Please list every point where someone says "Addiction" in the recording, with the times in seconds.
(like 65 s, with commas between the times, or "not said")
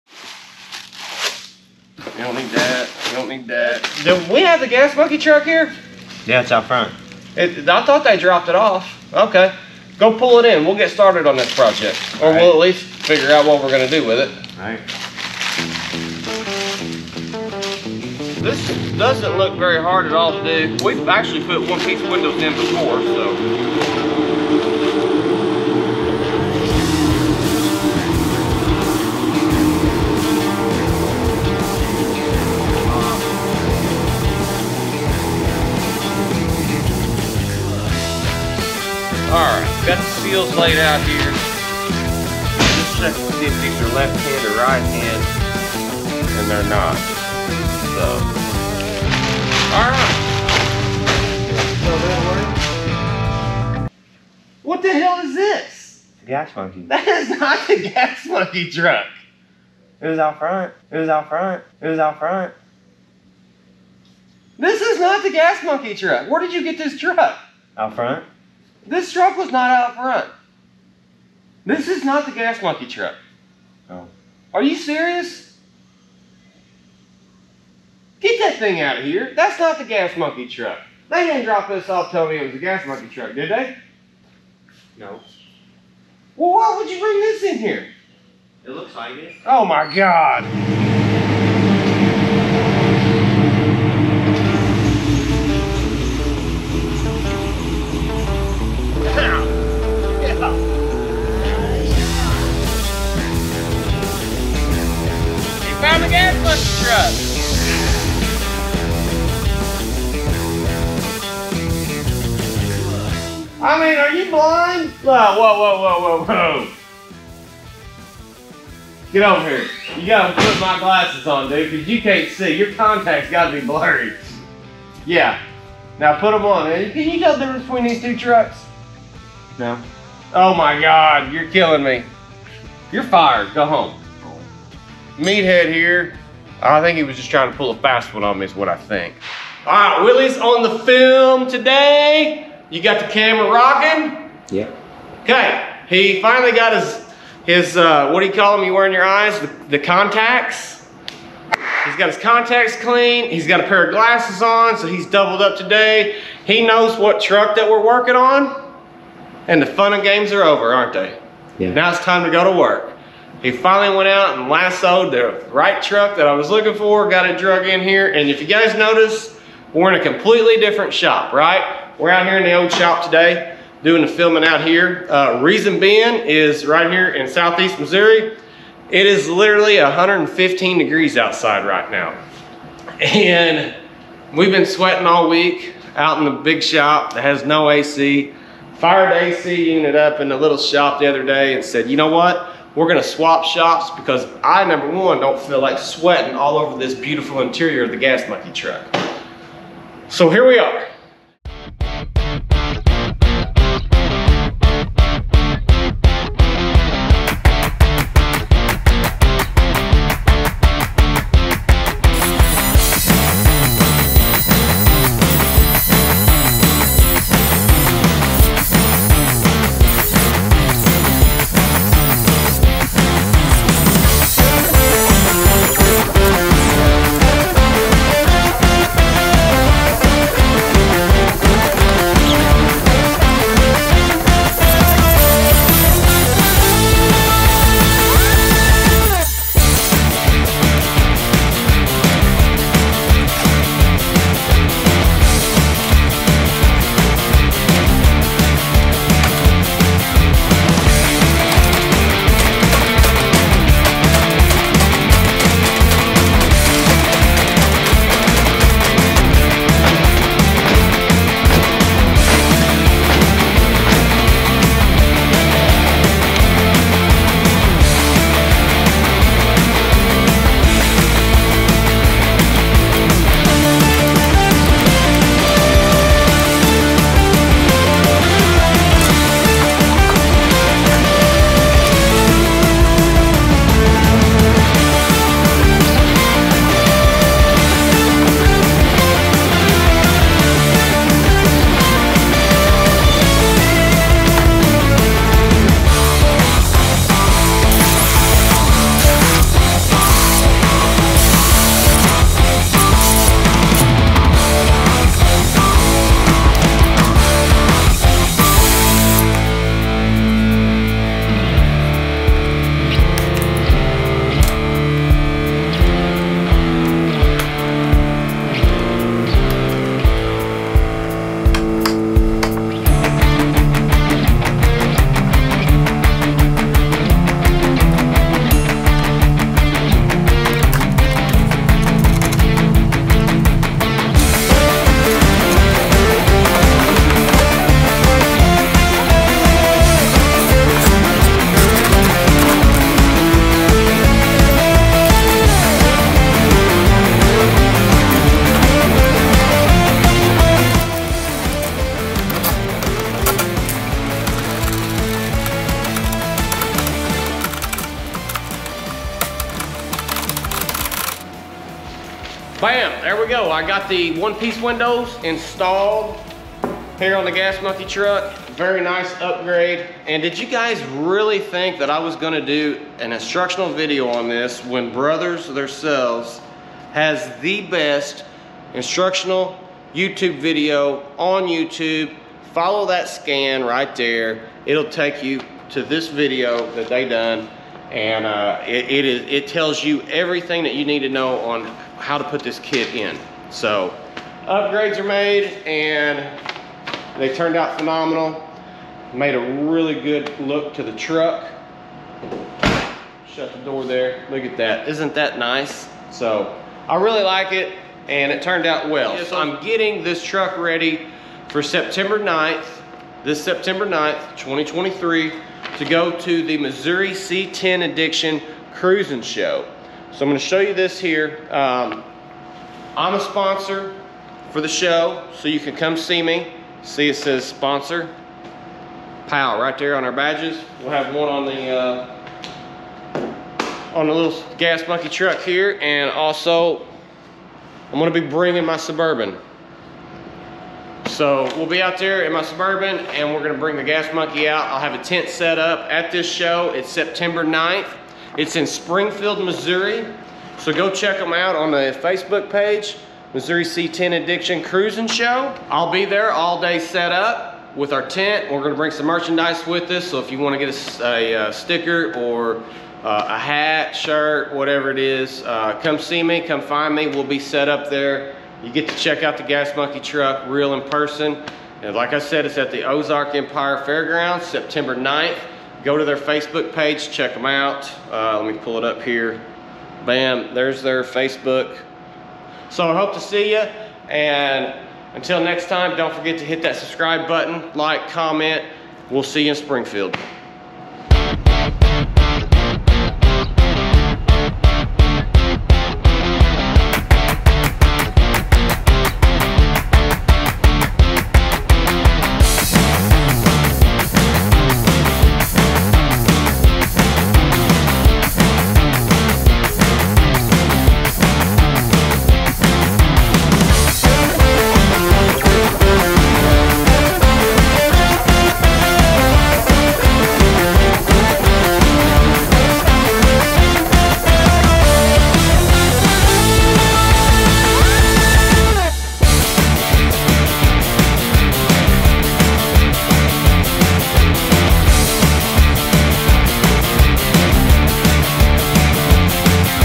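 417 s, 454 s.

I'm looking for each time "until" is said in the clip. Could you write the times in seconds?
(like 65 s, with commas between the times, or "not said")
485 s.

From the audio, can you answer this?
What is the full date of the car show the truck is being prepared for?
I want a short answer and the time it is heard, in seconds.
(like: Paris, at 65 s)
September 9th, 2023, at 413 s.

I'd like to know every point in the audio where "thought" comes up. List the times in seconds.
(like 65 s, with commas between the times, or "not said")
7 s.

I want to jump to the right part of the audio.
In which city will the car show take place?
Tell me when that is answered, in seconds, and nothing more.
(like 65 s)
448 s.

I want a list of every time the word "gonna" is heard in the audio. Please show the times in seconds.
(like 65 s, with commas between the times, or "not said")
192 s, 372 s, 420 s, 437 s, 443 s, 458 s.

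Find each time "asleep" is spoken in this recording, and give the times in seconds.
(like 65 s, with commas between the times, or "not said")
not said.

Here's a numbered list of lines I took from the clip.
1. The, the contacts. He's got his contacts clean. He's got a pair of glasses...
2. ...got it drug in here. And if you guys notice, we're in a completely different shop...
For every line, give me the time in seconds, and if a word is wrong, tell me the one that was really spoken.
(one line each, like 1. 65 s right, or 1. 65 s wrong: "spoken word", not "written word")
1. 149 s right
2. 167 s right.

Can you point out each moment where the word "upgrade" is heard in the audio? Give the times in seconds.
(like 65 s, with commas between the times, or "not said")
369 s, 394 s.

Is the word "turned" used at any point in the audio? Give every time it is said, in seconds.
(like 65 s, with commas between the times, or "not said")
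397 s, 408 s.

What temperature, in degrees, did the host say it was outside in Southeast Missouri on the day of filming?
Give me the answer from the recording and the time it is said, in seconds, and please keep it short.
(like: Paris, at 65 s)
115, at 179 s.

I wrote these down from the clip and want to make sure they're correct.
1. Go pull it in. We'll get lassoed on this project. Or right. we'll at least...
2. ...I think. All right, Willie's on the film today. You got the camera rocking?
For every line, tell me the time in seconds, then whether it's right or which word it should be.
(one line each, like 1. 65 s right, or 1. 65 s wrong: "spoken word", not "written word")
1. 9 s wrong: "started", not "lassoed"
2. 138 s right.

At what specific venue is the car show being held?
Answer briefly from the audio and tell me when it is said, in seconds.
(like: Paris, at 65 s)
Ozark Empire Fairgrounds, at 472 s.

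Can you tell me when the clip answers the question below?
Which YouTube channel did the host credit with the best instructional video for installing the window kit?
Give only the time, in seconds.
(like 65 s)
374 s.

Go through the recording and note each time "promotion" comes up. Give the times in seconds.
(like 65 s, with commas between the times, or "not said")
not said.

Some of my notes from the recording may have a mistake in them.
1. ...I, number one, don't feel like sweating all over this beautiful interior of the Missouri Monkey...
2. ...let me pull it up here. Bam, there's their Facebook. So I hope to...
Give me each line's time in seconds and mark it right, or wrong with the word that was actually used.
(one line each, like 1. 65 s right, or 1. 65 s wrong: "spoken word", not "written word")
1. 194 s wrong: "Gas", not "Missouri"
2. 478 s right.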